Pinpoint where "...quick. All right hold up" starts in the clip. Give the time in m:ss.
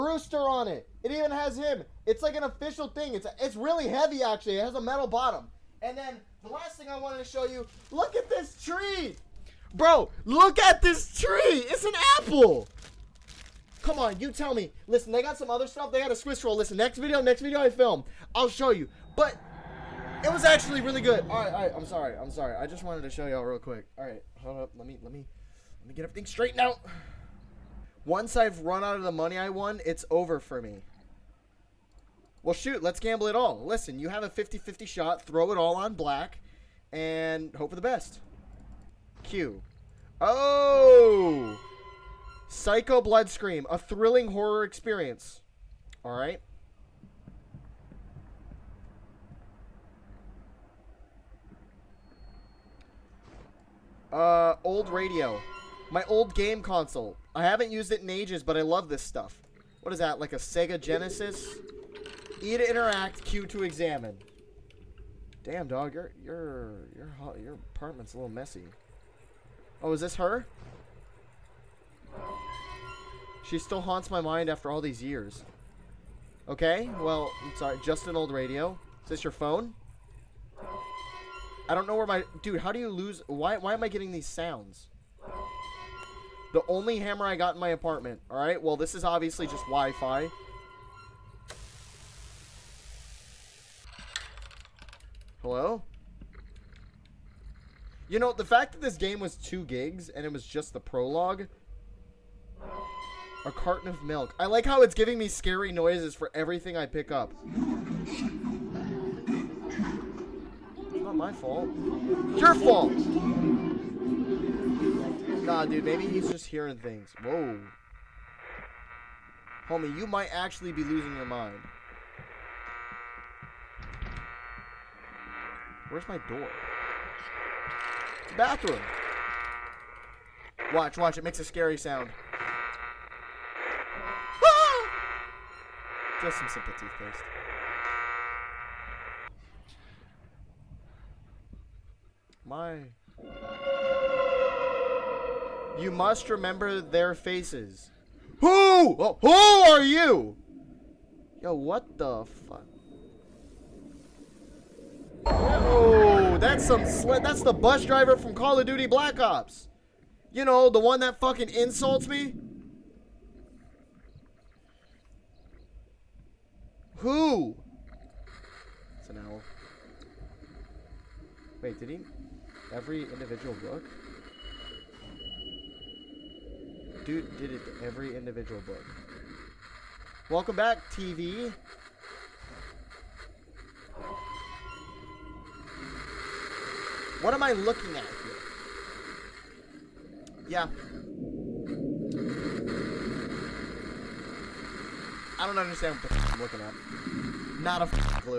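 0:23.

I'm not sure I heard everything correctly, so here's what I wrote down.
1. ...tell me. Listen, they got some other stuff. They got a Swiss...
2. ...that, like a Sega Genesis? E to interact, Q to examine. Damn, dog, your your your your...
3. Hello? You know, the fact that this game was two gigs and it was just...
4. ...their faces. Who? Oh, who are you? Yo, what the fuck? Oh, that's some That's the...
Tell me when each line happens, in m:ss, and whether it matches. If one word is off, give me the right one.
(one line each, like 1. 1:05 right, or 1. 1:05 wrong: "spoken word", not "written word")
1. 0:14 right
2. 0:59 right
3. 1:35 right
4. 2:26 right.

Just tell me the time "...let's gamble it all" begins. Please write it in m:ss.
0:32.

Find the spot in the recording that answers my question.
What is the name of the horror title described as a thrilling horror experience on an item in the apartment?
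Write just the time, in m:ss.
0:42.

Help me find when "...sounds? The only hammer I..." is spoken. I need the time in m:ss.
1:24.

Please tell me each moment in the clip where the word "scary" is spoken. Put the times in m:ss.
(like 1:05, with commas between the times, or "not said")
1:45, 2:11.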